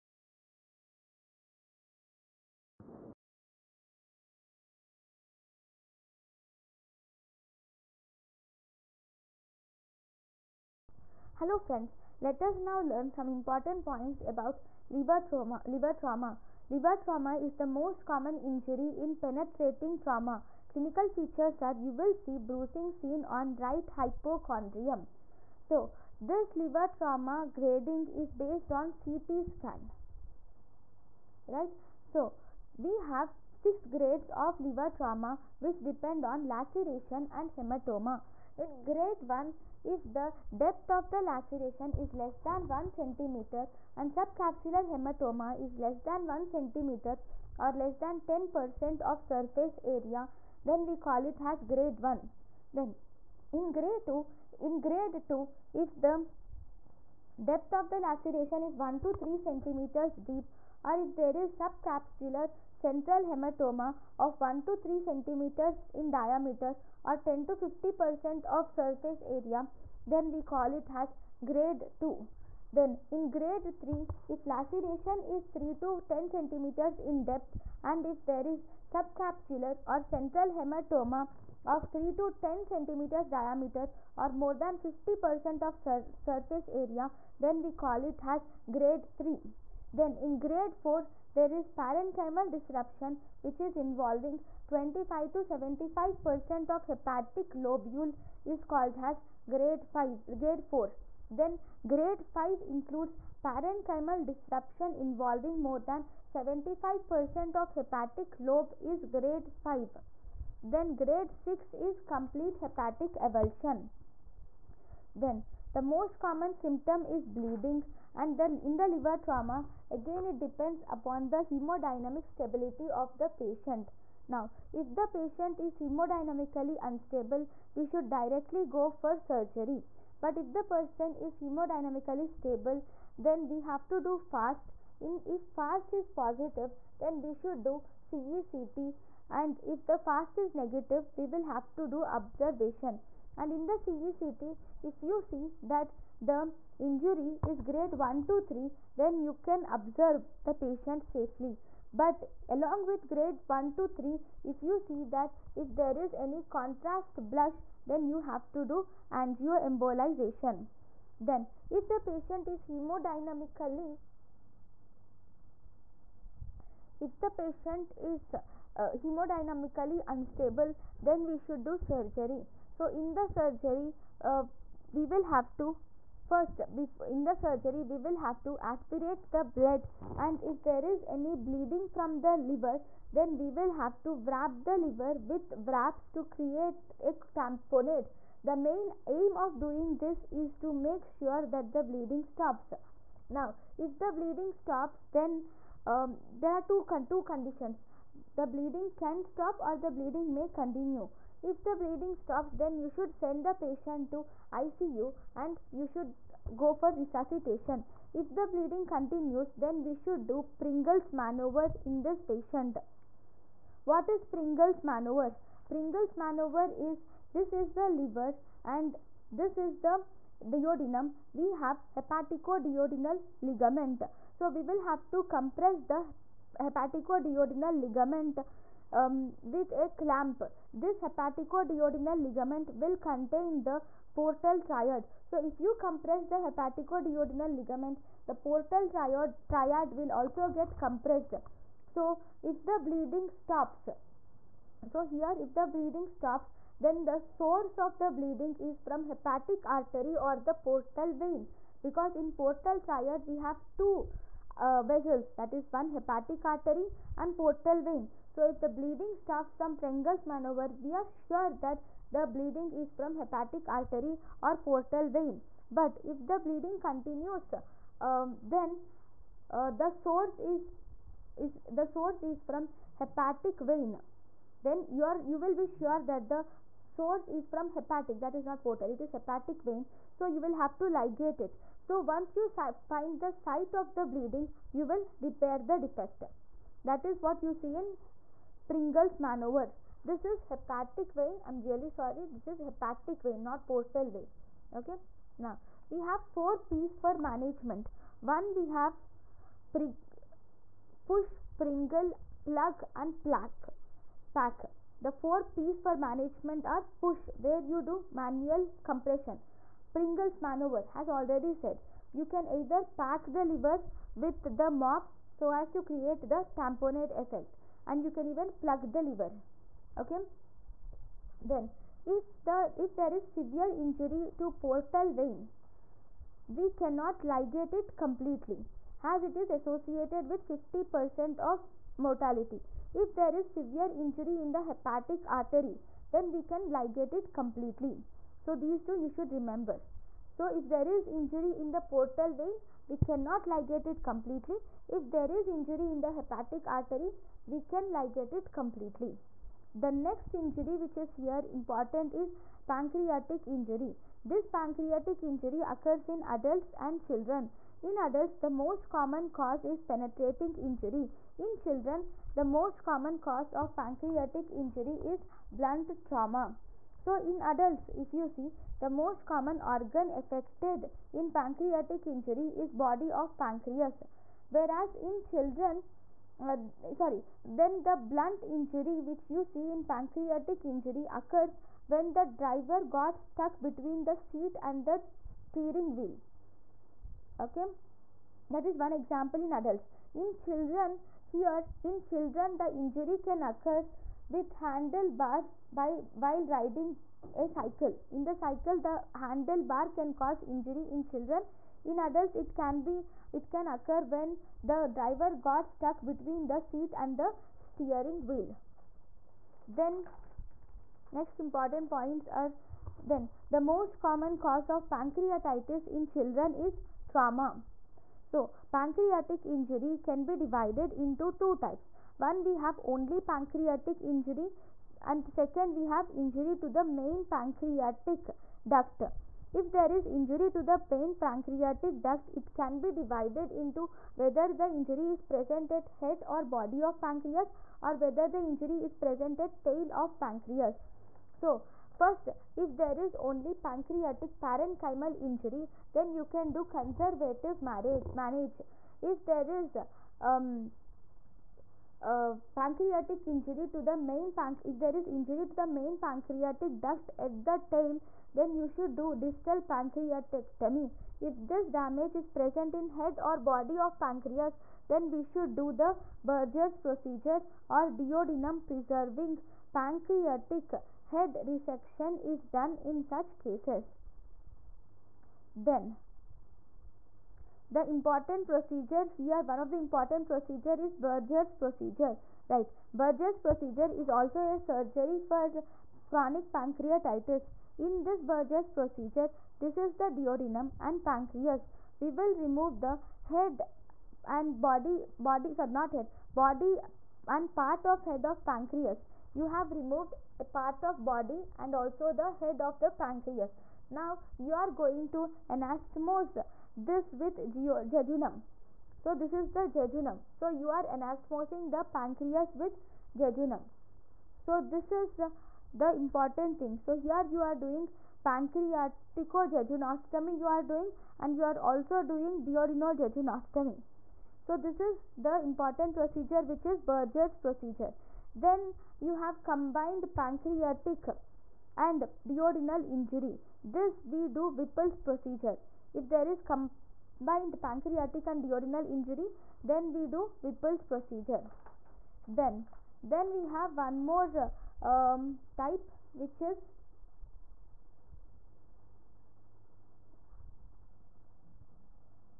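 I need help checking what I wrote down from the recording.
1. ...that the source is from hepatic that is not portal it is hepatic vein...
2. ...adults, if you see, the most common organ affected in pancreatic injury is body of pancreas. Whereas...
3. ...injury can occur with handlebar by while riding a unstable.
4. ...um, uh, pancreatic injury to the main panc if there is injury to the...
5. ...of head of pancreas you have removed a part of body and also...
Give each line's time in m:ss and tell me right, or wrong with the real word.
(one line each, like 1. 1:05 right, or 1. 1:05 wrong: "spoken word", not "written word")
1. 4:36 right
2. 6:07 right
3. 6:32 wrong: "cycle", not "unstable"
4. 7:30 right
5. 8:17 right.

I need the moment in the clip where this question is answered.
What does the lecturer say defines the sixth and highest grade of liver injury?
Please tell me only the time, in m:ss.
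1:52.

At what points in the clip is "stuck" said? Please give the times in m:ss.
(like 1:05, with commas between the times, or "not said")
6:23, 6:45.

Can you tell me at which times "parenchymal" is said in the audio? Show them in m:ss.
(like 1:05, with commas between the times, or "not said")
1:31, 1:43, 7:24.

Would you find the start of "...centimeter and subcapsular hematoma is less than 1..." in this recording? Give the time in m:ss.
0:42.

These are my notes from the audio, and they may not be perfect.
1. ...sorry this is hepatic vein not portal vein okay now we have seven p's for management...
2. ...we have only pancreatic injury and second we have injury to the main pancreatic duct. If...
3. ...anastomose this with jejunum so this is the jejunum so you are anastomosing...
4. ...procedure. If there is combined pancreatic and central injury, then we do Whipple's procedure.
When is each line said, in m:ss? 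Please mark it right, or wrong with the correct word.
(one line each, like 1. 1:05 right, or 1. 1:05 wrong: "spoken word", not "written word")
1. 4:51 wrong: "four", not "seven"
2. 7:02 right
3. 8:25 right
4. 8:54 wrong: "duodenal", not "central".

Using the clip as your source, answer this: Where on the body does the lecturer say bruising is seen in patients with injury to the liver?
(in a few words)
Right hypochondrium.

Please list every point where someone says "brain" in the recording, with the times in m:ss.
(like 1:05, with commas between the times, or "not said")
not said.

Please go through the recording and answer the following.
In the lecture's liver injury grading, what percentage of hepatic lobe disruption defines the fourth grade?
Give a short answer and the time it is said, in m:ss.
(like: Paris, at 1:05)
25 to 75%, at 1:34.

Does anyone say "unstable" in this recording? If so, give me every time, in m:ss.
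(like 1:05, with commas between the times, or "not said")
2:06, 2:50.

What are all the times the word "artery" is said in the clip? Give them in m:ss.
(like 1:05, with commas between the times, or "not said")
4:09, 4:16, 4:23, 5:35, 5:46.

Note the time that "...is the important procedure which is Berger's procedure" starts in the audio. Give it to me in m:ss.
8:44.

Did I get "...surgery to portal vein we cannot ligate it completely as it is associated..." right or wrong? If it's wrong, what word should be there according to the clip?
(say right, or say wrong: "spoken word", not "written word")
wrong: "injury", not "surgery".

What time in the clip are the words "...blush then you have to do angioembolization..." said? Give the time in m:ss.
2:37.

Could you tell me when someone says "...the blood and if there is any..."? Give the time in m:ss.
2:59.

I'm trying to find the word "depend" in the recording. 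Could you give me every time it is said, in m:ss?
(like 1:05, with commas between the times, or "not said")
0:35, 2:00.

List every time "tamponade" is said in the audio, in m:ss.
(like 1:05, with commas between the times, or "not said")
3:07, 5:16.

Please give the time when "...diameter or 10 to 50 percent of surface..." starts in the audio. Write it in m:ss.
1:06.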